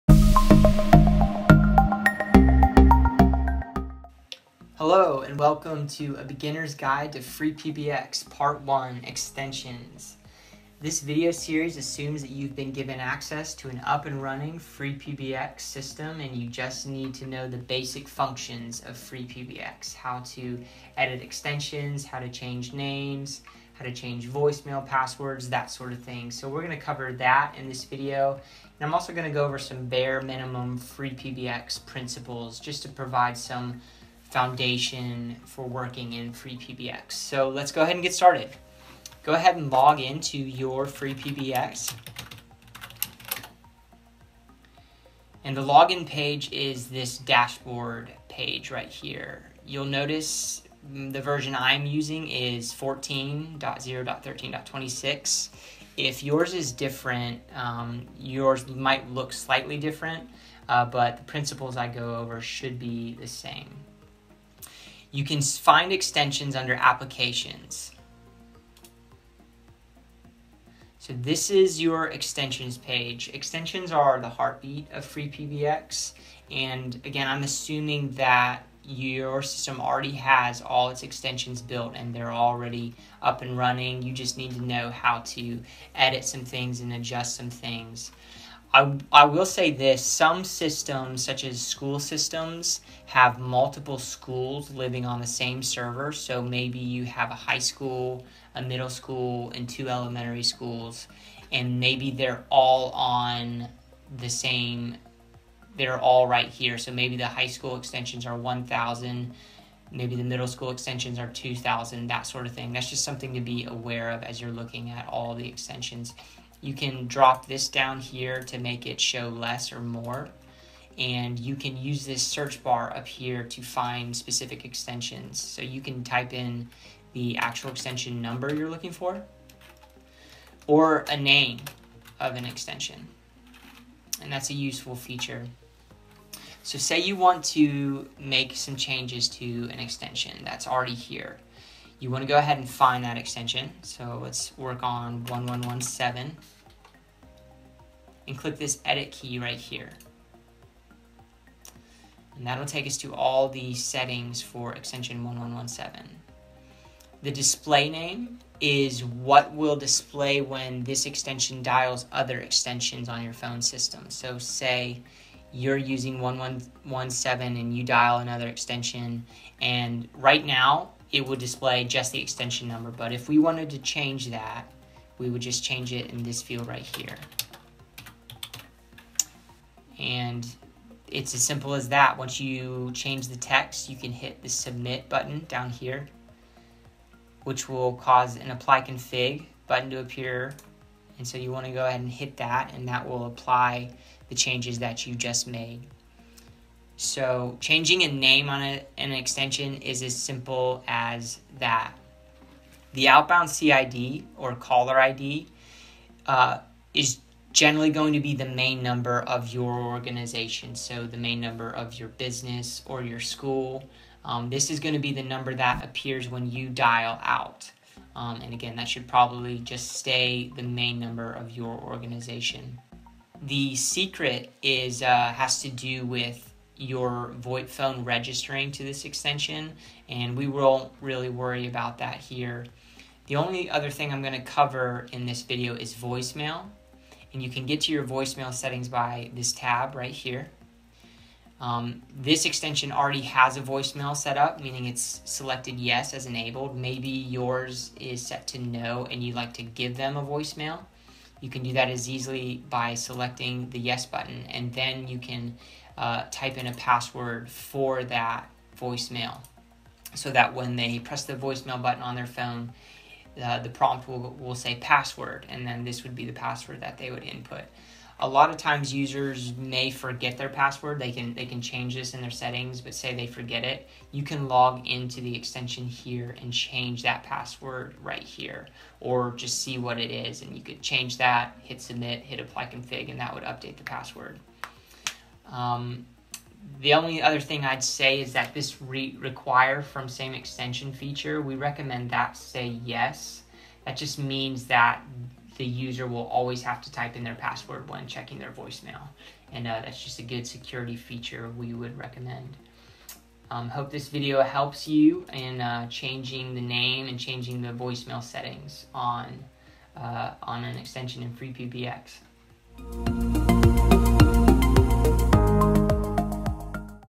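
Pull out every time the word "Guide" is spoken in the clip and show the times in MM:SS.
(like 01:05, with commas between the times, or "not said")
00:06.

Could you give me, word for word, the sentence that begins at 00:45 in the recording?
And the login page is this dashboard page right here.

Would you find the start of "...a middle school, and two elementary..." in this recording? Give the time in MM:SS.
01:38.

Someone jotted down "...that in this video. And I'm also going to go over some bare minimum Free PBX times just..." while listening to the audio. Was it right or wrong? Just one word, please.
wrong.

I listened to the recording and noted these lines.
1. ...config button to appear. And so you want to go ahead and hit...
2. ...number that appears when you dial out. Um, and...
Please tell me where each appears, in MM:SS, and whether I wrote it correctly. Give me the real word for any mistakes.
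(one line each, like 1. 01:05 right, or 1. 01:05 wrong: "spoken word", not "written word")
1. 03:08 right
2. 03:35 right.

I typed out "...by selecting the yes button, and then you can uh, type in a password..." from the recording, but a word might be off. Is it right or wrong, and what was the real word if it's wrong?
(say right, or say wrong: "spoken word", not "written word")
right.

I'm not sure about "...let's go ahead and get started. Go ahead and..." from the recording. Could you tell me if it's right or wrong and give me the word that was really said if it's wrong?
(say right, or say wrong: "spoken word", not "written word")
right.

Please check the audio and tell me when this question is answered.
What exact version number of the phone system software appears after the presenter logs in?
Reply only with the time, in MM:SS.
00:52.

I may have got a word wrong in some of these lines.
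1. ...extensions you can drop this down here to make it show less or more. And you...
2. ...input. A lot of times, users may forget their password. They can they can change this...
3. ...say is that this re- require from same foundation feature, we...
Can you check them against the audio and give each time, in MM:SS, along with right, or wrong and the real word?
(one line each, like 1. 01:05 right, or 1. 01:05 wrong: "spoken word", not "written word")
1. 01:55 right
2. 04:27 right
3. 04:47 wrong: "extension", not "foundation".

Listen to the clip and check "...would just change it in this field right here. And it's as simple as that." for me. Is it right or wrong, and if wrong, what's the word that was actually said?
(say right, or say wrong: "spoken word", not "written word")
right.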